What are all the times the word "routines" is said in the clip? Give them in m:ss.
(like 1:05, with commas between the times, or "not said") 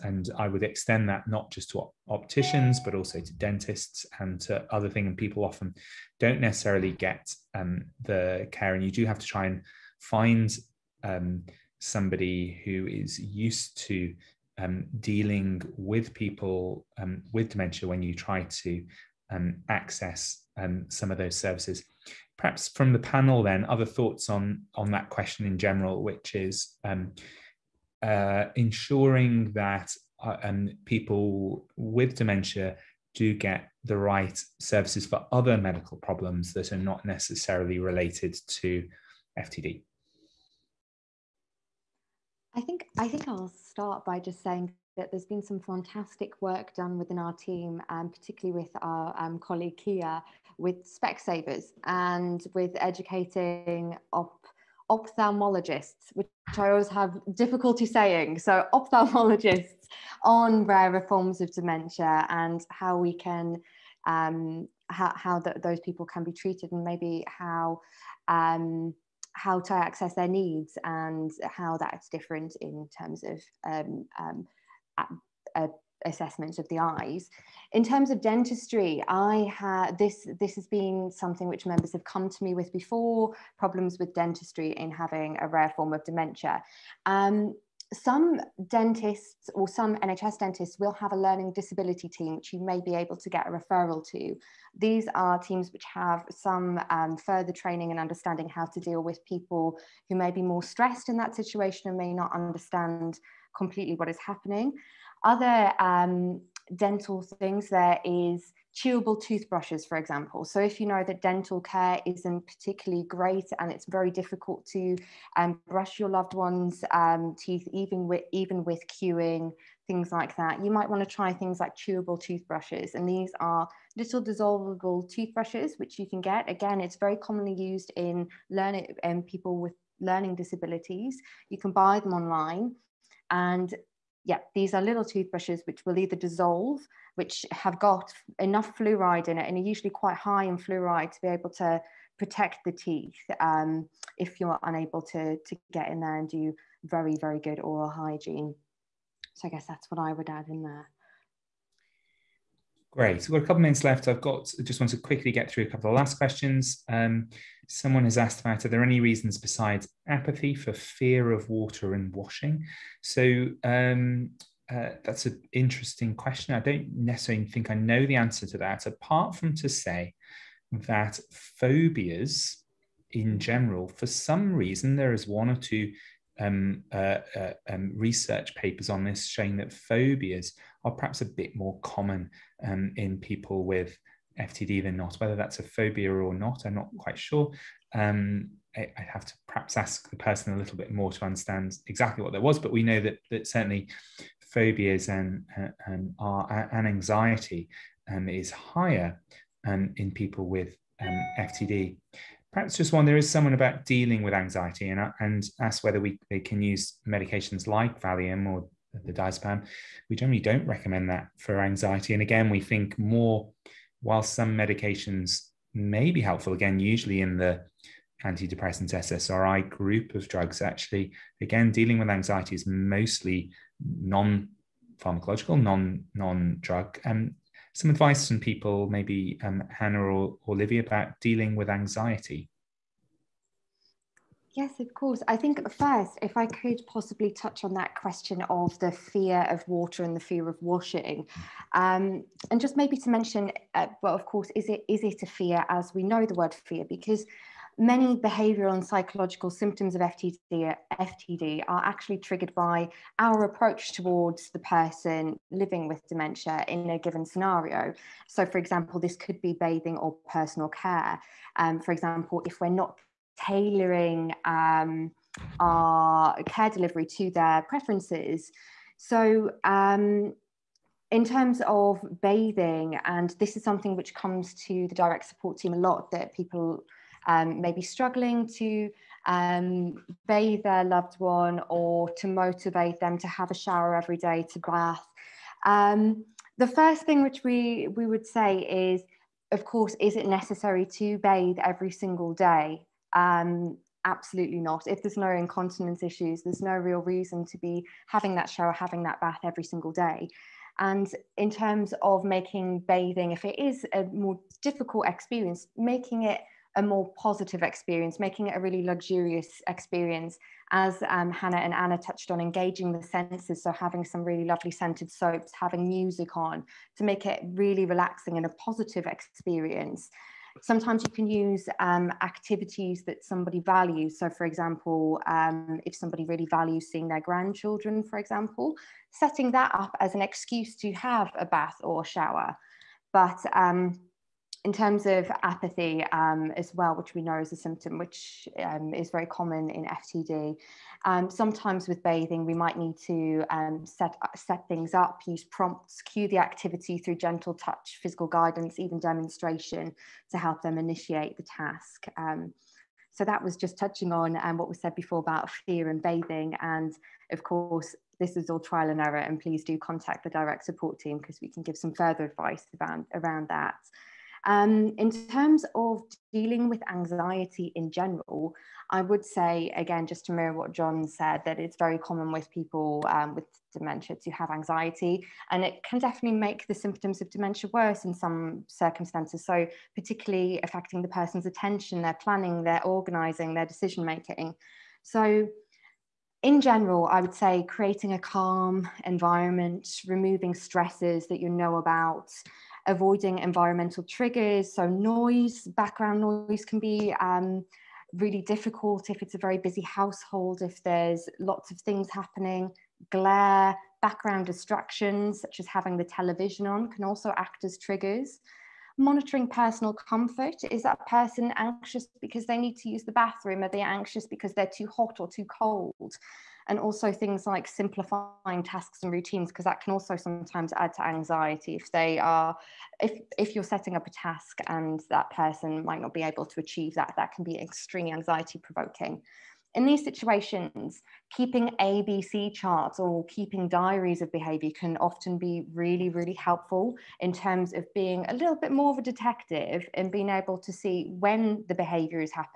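6:59.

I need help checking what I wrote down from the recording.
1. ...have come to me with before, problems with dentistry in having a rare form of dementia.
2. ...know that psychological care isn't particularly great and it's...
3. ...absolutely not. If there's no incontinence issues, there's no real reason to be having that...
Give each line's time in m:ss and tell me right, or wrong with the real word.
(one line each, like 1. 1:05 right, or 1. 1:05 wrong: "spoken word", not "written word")
1. 1:21 right
2. 1:50 wrong: "dental", not "psychological"
3. 4:54 right.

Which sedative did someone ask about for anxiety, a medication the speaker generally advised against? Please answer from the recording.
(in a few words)
diazepam.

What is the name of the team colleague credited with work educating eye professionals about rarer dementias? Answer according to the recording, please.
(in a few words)
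Kia.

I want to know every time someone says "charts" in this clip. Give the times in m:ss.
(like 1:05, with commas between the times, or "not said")
7:12.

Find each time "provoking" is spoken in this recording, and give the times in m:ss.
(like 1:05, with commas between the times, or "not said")
7:08.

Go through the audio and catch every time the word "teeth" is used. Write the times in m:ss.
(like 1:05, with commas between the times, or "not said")
1:57, 2:22.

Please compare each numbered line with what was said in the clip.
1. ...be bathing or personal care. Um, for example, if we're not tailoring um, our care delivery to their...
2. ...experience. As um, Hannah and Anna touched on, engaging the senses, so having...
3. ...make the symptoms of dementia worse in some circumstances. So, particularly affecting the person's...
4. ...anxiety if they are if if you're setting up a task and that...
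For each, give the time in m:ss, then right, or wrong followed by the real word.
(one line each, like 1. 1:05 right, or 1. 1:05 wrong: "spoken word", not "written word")
1. 4:19 right
2. 5:09 right
3. 6:16 right
4. 7:01 right.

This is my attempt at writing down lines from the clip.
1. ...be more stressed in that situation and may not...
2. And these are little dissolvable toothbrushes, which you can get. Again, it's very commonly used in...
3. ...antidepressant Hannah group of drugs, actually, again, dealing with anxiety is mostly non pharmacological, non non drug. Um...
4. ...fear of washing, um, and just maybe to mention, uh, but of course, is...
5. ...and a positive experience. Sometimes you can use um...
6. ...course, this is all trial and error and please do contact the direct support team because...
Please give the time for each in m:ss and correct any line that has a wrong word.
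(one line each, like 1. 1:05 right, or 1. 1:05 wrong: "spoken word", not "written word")
1. 1:40 right
2. 2:02 right
3. 3:38 wrong: "SSRI", not "Hannah"
4. 4:00 right
5. 5:18 right
6. 5:57 right.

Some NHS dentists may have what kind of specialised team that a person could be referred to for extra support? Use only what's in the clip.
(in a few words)
learning disability team.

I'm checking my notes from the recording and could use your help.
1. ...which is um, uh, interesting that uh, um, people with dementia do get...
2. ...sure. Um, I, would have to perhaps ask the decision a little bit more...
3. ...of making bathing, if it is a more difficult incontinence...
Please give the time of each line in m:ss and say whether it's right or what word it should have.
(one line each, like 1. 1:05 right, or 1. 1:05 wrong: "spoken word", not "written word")
1. 0:26 wrong: "ensuring", not "interesting"
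2. 3:07 wrong: "person", not "decision"
3. 5:02 wrong: "experience", not "incontinence".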